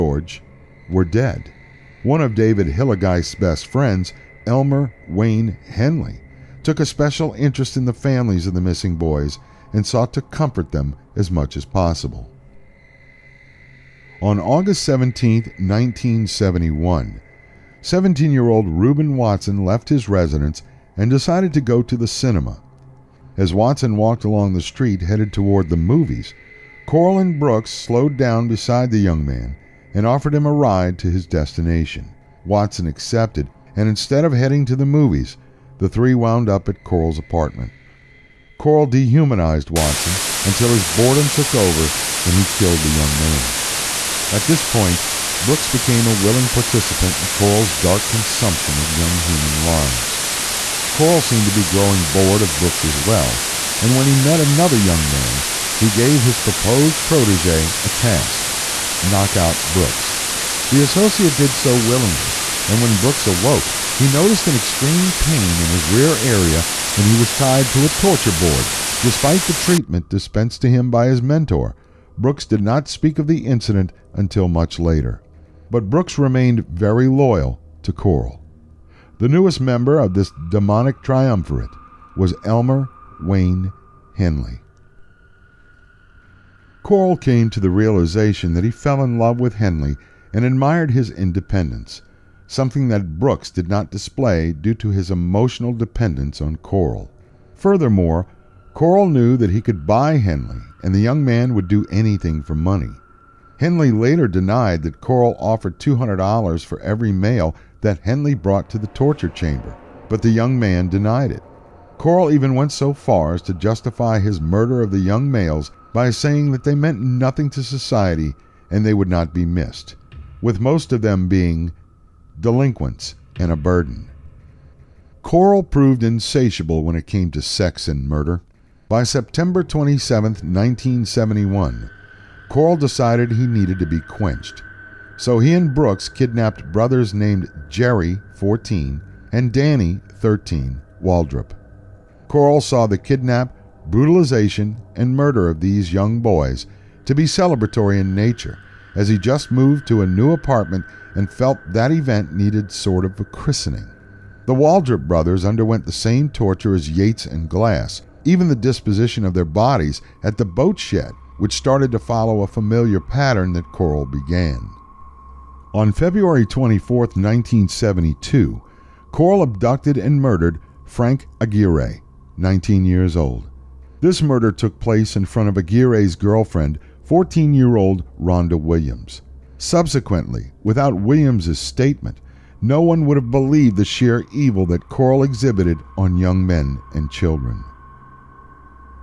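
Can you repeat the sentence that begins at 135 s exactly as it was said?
So he and Brooks kidnapped brothers named Jerry, 14, and Danny, 13, Waldrop.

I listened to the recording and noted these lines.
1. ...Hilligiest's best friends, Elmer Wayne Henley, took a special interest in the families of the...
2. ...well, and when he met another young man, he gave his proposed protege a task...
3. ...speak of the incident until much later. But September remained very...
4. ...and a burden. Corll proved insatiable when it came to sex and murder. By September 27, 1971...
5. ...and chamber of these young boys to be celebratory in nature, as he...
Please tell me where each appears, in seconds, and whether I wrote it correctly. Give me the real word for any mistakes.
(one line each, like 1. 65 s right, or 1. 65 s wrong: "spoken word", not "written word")
1. 2 s right
2. 52 s right
3. 72 s wrong: "Brooks", not "September"
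4. 123 s right
5. 144 s wrong: "murder", not "chamber".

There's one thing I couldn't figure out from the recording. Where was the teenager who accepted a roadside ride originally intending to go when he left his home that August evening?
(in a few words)
the cinema.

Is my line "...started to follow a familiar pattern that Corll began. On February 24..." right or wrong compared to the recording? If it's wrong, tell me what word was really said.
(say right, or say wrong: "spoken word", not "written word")
right.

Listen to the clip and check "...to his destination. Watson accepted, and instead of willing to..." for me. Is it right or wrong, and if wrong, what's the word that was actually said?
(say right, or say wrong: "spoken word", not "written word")
wrong: "heading", not "willing".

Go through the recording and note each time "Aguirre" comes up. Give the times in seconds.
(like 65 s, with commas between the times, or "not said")
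171 s, 175 s.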